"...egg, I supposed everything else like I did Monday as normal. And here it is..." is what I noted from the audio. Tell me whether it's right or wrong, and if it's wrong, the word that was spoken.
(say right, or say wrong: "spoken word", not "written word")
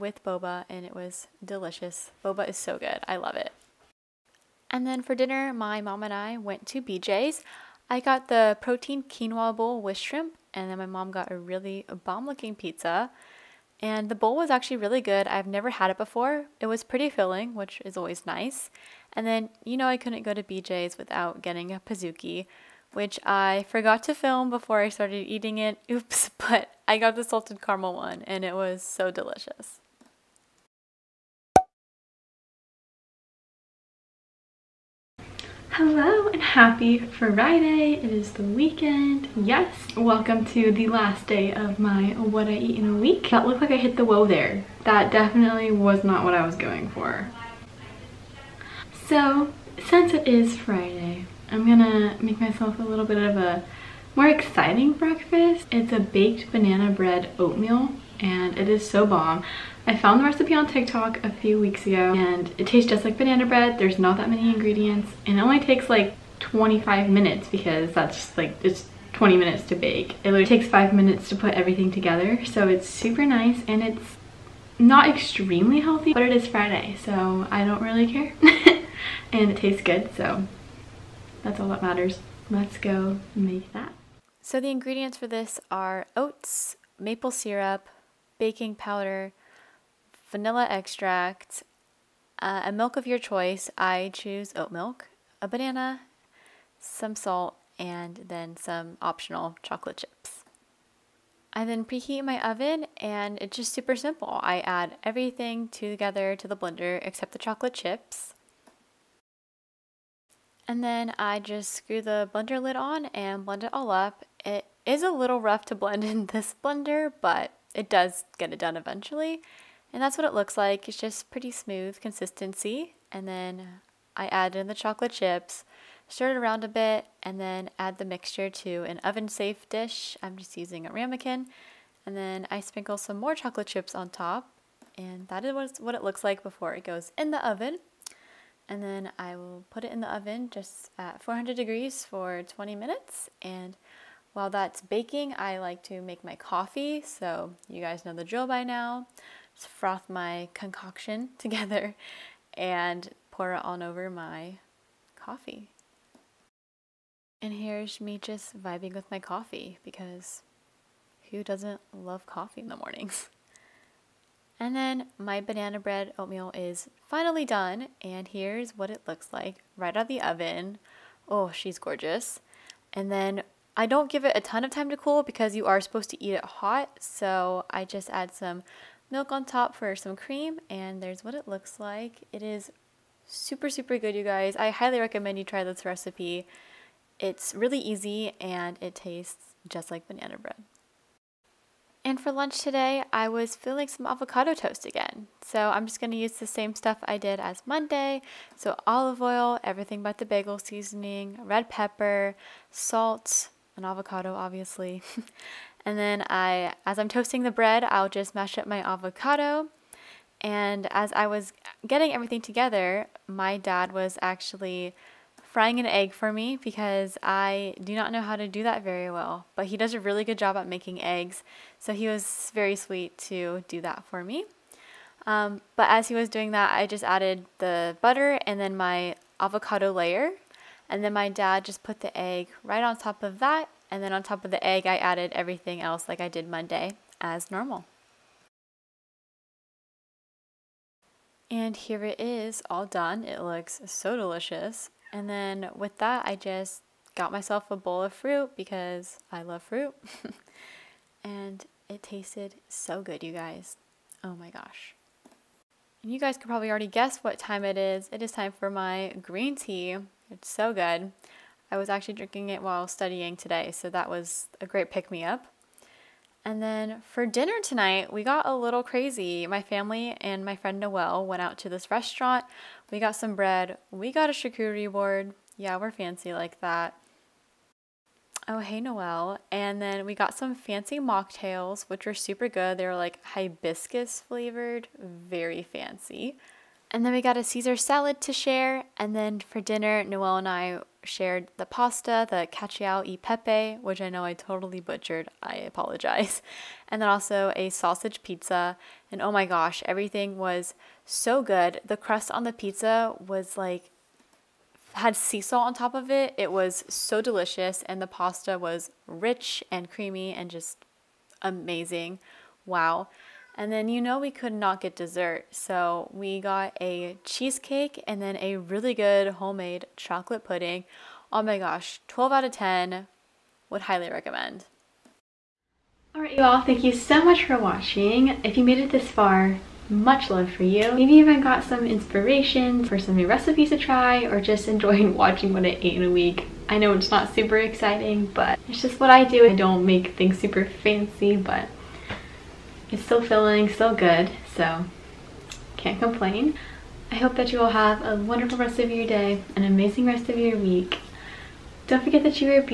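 wrong: "added", not "supposed".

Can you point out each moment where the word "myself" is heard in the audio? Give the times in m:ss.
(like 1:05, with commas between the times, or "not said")
0:52, 4:07.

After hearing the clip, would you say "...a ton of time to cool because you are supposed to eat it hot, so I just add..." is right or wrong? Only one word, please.
right.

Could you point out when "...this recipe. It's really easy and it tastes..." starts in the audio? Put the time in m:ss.
3:05.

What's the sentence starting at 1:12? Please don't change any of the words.
So it's super nice and it's not extremely healthy, but it is Friday, so I don't really care.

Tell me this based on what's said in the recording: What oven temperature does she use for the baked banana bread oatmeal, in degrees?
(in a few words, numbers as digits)
400.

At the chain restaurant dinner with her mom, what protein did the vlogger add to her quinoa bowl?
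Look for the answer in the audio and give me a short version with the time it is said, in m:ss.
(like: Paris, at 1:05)
Shrimp, at 0:09.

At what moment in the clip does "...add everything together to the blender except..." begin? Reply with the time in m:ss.
1:44.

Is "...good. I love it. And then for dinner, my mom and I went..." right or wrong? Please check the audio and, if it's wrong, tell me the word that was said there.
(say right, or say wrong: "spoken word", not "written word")
right.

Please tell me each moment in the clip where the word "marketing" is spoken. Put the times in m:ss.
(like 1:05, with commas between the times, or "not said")
not said.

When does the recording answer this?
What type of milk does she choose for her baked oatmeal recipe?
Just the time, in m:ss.
1:34.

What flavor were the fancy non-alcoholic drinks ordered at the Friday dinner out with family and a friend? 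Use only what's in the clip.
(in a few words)
Hibiscus.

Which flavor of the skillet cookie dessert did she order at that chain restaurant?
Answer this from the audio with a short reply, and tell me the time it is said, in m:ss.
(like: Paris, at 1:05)
Salted caramel, at 0:27.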